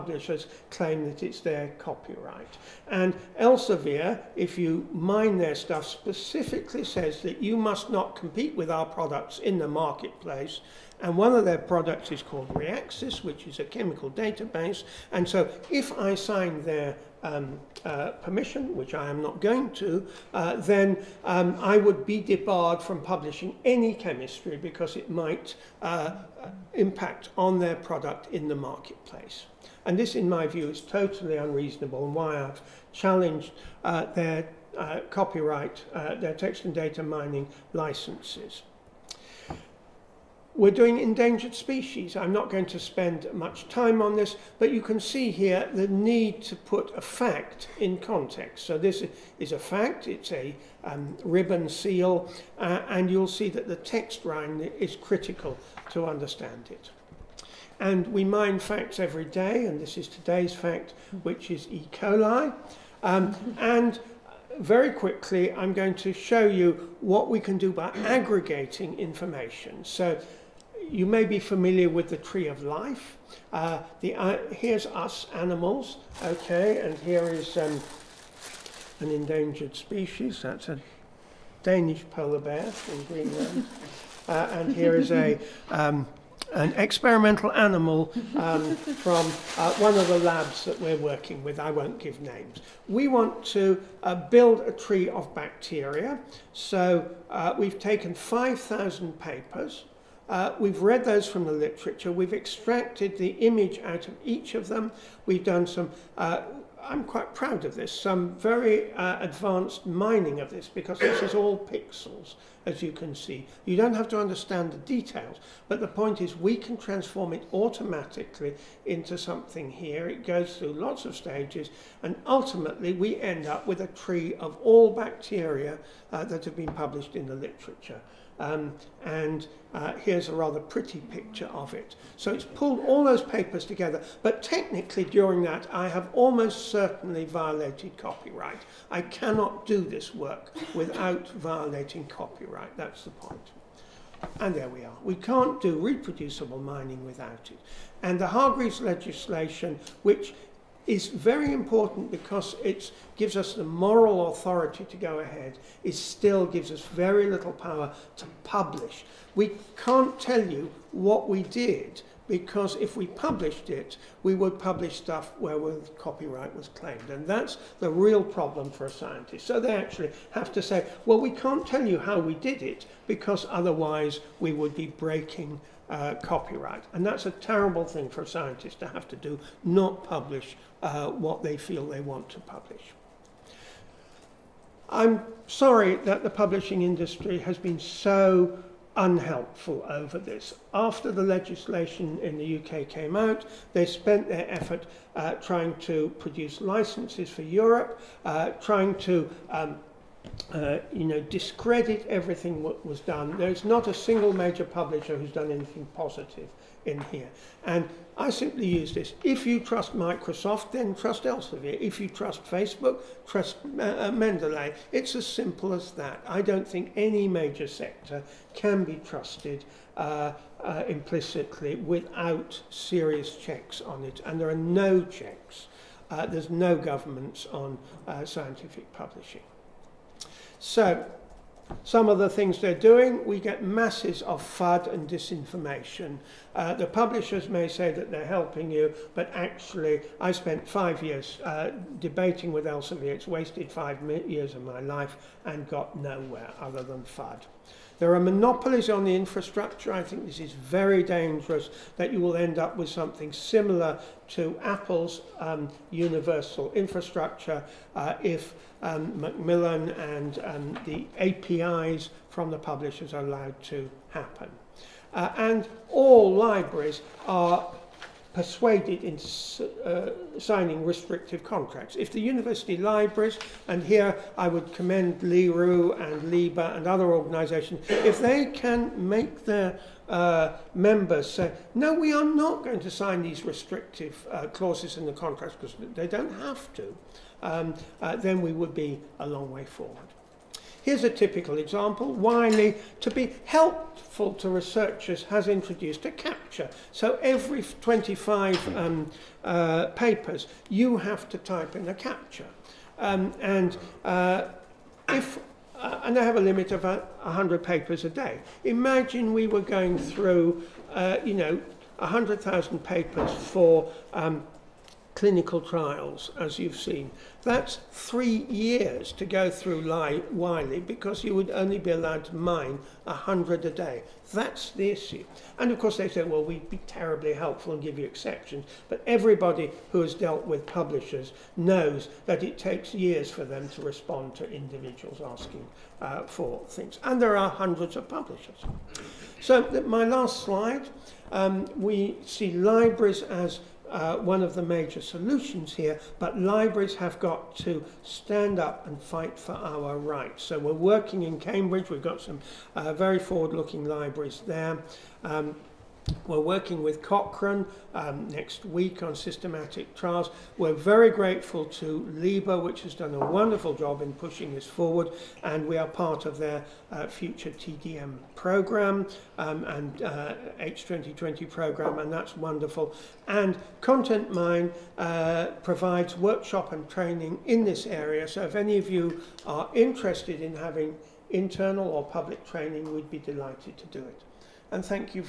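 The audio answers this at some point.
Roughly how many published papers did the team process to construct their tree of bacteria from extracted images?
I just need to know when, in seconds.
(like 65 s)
98 s.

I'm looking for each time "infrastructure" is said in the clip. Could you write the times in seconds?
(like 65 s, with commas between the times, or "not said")
249 s, 256 s.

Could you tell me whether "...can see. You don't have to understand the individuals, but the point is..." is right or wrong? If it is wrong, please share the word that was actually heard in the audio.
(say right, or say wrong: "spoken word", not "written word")
wrong: "details", not "individuals".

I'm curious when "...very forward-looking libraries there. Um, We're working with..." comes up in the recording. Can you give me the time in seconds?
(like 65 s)
352 s.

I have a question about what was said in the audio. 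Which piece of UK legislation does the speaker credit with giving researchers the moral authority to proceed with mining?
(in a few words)
Hargreaves legislation.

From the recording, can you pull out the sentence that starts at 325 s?
And of course, they say, well, we'd be terribly helpful and give you exceptions.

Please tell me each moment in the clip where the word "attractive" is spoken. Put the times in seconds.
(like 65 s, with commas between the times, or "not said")
not said.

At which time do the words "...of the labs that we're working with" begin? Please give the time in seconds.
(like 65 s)
89 s.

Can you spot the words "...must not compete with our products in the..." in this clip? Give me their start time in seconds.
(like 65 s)
7 s.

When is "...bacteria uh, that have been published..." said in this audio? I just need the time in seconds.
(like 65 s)
124 s.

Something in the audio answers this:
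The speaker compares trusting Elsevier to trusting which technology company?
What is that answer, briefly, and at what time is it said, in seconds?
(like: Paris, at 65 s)
Microsoft, at 209 s.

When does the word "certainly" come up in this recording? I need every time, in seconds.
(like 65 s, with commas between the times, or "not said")
136 s.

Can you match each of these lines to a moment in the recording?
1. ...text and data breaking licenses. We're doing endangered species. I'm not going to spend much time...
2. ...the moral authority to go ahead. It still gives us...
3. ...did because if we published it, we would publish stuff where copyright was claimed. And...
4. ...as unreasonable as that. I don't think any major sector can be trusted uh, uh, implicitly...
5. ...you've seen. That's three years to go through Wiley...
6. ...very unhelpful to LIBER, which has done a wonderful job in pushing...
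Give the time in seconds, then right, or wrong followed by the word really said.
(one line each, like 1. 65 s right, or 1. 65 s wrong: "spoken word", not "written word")
1. 36 s wrong: "mining", not "breaking"
2. 153 s right
3. 161 s right
4. 215 s wrong: "simple", not "unreasonable"
5. 316 s right
6. 360 s wrong: "grateful", not "unhelpful".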